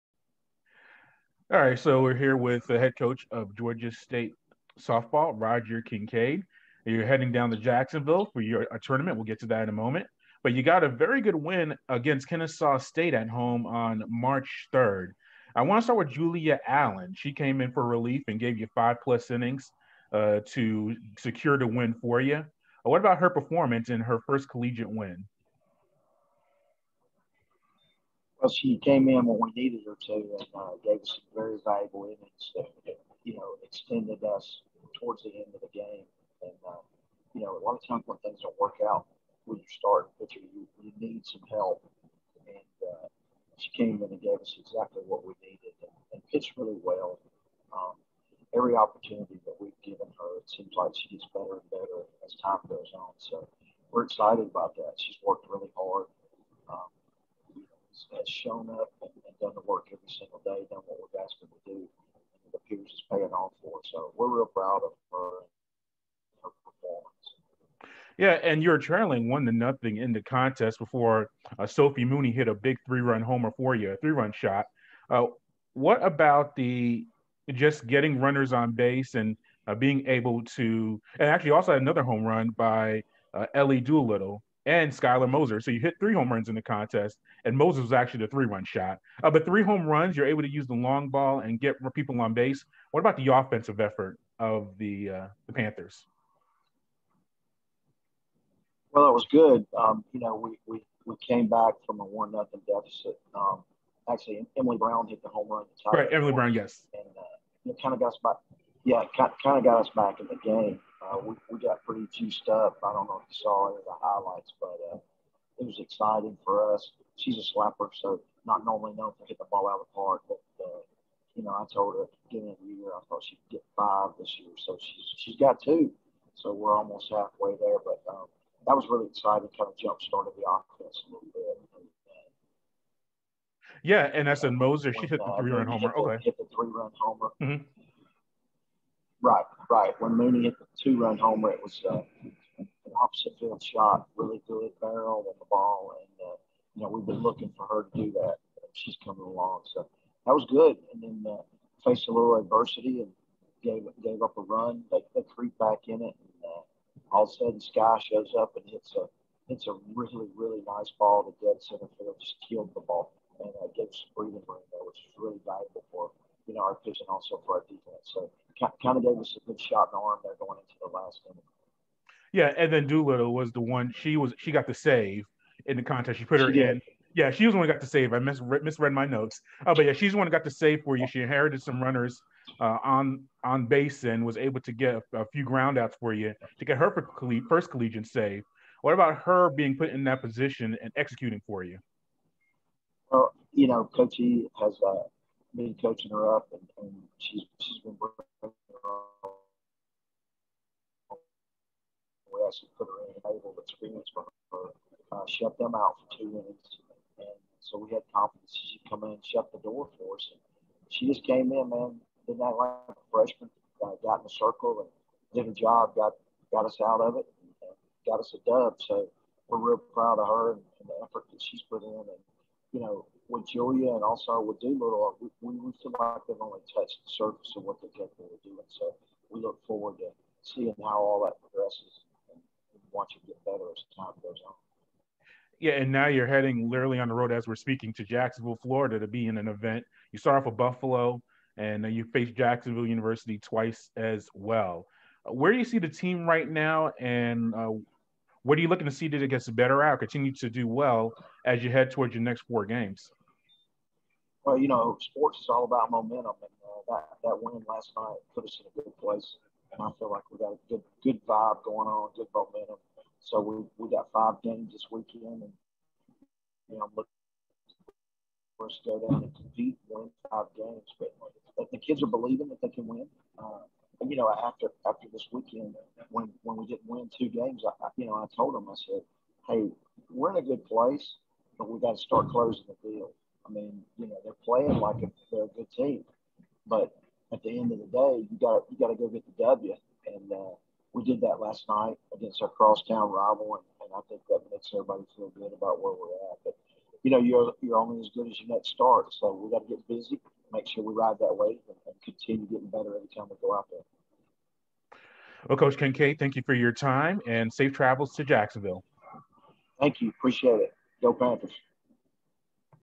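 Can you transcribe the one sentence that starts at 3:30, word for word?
And she just came in, man, didn't act like a freshman.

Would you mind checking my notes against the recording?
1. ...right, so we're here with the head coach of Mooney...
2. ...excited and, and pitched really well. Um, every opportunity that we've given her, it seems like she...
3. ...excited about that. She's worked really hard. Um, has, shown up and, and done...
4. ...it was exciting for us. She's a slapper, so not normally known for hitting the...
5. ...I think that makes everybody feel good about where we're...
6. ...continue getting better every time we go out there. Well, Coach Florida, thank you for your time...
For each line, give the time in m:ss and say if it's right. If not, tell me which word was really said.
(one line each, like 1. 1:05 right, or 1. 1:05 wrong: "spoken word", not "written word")
1. 0:01 wrong: "Georgia", not "Mooney"
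2. 0:45 wrong: "needed", not "excited"
3. 0:54 right
4. 1:55 right
5. 4:53 right
6. 5:02 wrong: "Kincaid", not "Florida".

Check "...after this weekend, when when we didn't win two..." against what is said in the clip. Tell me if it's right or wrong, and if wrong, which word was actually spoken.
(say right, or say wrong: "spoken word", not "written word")
right.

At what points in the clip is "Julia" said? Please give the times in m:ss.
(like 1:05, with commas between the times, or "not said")
0:16, 3:43.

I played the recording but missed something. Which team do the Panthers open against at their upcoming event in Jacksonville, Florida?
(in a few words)
Buffalo.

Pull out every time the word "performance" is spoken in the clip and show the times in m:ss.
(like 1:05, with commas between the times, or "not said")
0:23, 1:06.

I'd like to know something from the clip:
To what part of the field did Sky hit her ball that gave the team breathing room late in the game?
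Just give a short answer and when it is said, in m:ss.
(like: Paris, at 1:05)
dead center field, at 2:41.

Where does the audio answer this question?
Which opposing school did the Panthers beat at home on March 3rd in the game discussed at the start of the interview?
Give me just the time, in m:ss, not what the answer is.
0:12.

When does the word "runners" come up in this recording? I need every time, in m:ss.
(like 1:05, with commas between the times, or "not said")
1:18, 3:01.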